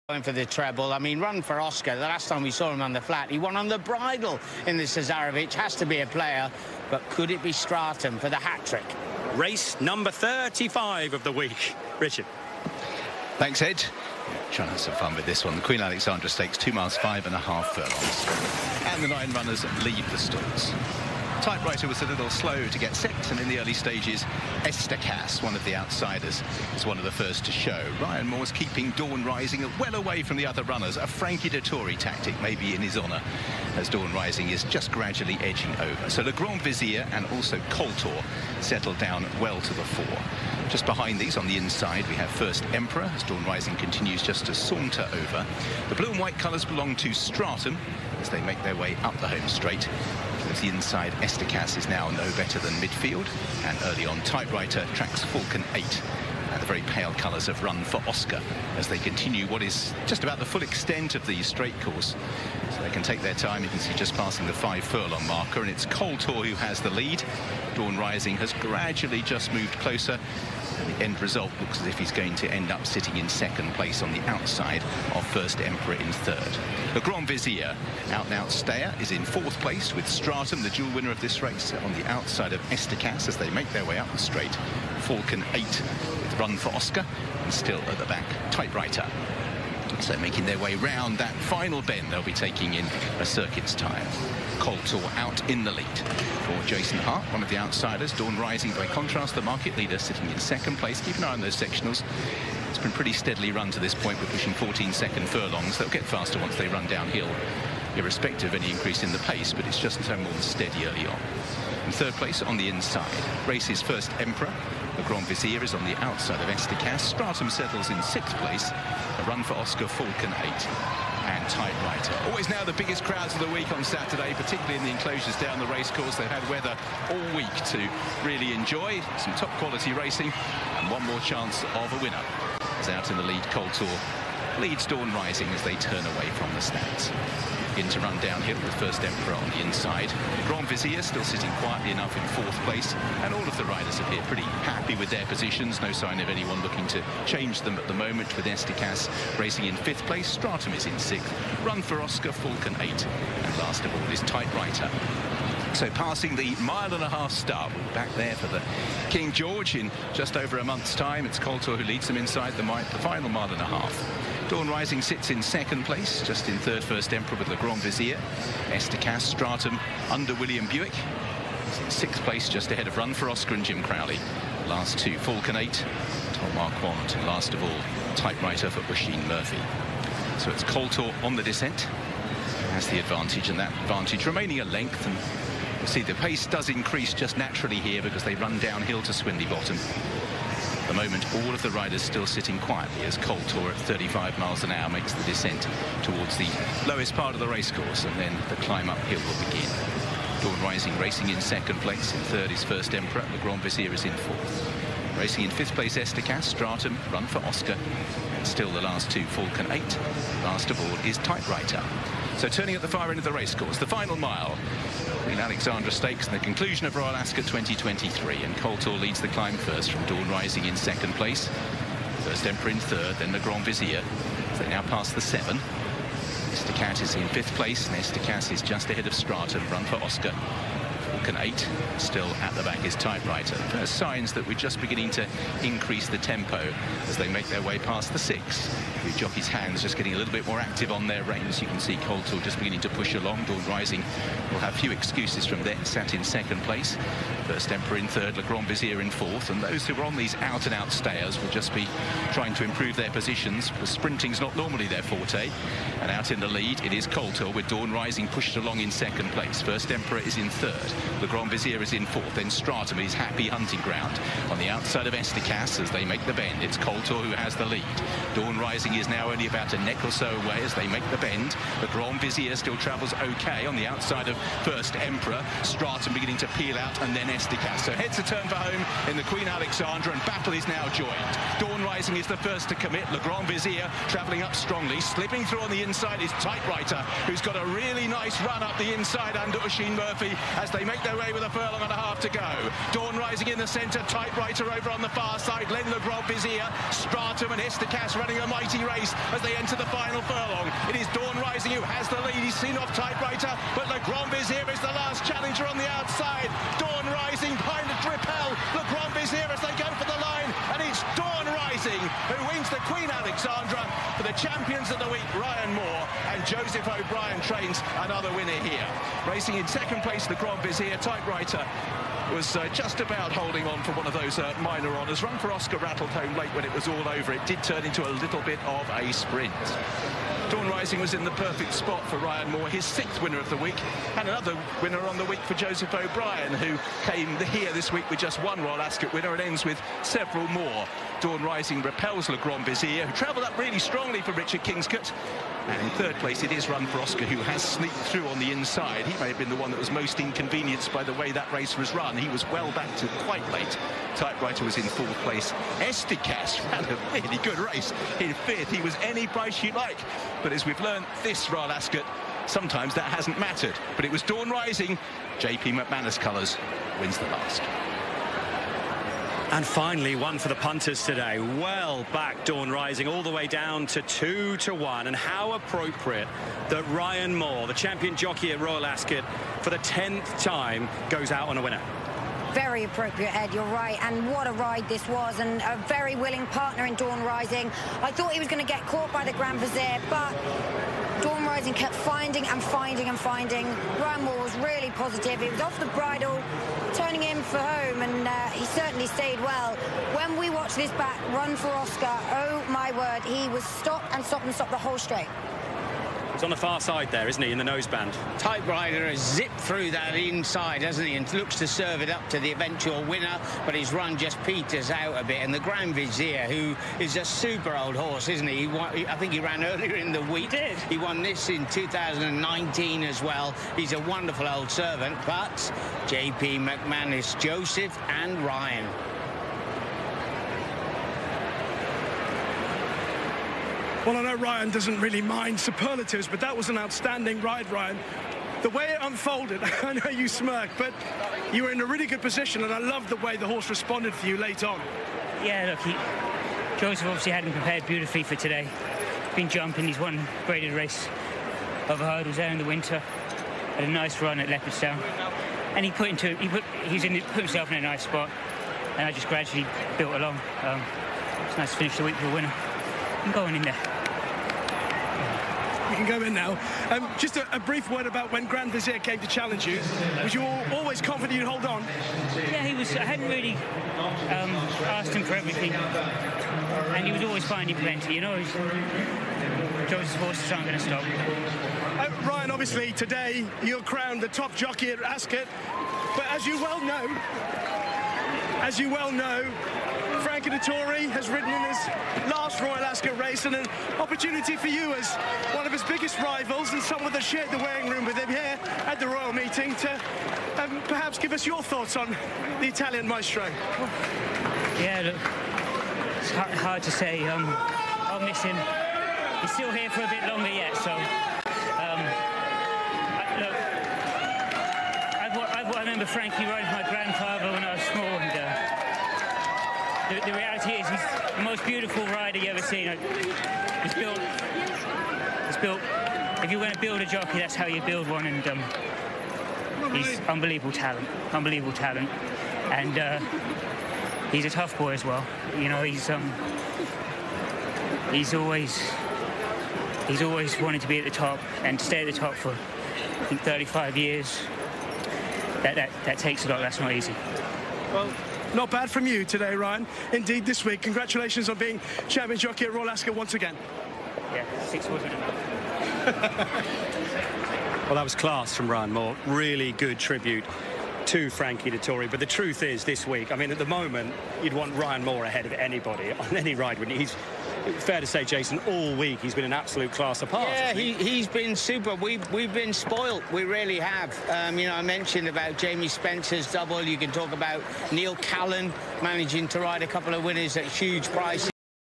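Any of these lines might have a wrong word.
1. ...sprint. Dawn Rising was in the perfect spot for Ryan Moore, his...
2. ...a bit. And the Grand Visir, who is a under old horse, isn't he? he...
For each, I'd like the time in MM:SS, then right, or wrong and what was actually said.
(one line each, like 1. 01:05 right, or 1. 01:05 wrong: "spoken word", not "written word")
1. 05:29 right
2. 06:55 wrong: "super", not "under".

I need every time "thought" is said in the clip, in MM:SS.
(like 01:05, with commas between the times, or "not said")
06:28, 08:21.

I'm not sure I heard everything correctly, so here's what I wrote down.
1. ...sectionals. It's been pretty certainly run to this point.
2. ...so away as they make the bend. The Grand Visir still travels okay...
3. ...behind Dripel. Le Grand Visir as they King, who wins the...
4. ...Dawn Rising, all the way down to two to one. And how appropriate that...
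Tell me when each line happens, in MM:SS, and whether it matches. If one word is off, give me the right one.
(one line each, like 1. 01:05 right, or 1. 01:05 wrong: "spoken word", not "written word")
1. 01:41 wrong: "steadily", not "certainly"
2. 04:30 right
3. 05:07 right
4. 06:12 right.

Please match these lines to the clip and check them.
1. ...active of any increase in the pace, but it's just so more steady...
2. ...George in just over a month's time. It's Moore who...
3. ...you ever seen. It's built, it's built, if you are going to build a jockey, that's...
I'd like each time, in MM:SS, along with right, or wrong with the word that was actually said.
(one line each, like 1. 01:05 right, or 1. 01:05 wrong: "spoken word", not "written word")
1. 01:47 wrong: "irrespective", not "active"
2. 02:39 wrong: "Coltor", not "Moore"
3. 08:42 right.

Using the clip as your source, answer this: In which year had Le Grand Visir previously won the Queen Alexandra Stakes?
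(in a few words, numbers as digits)
2019.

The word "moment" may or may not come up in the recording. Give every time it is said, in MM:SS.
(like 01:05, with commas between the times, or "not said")
02:27, 03:10, 09:23.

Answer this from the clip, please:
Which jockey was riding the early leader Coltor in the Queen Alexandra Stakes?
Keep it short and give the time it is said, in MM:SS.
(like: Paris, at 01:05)
Jason Hart, at 01:36.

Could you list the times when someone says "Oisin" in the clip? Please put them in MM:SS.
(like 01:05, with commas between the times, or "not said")
02:58, 04:49.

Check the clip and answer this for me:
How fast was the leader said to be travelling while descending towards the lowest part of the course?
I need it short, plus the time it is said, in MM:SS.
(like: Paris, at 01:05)
35 miles an hour, at 03:13.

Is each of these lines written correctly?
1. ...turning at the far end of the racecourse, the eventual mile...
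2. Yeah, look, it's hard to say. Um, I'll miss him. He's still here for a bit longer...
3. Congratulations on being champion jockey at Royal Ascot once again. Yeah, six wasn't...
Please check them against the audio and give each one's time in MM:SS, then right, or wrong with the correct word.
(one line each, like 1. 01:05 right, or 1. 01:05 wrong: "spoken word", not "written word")
1. 03:32 wrong: "final", not "eventual"
2. 08:24 right
3. 09:10 right.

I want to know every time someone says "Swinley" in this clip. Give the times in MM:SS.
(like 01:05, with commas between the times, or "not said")
03:09.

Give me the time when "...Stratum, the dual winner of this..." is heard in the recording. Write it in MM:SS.
01:20.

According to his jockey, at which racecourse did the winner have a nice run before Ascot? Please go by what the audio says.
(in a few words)
Leopardstown.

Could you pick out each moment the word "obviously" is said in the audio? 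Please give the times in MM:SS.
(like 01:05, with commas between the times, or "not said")
07:27, 08:02.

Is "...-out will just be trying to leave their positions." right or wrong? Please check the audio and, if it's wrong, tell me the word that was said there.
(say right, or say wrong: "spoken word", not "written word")
wrong: "improve", not "leave".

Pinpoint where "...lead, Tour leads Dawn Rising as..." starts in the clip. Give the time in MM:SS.
02:13.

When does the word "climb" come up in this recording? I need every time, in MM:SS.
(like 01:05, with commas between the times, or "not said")
03:18, 03:39.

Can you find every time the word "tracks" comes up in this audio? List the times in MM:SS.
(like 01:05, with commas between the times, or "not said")
00:54.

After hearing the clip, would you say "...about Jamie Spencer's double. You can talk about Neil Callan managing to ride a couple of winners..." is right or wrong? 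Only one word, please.
right.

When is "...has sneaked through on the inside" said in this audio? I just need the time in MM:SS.
05:47.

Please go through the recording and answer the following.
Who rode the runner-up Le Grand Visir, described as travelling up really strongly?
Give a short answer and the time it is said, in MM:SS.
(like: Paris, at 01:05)
Richard Kingscote, at 05:44.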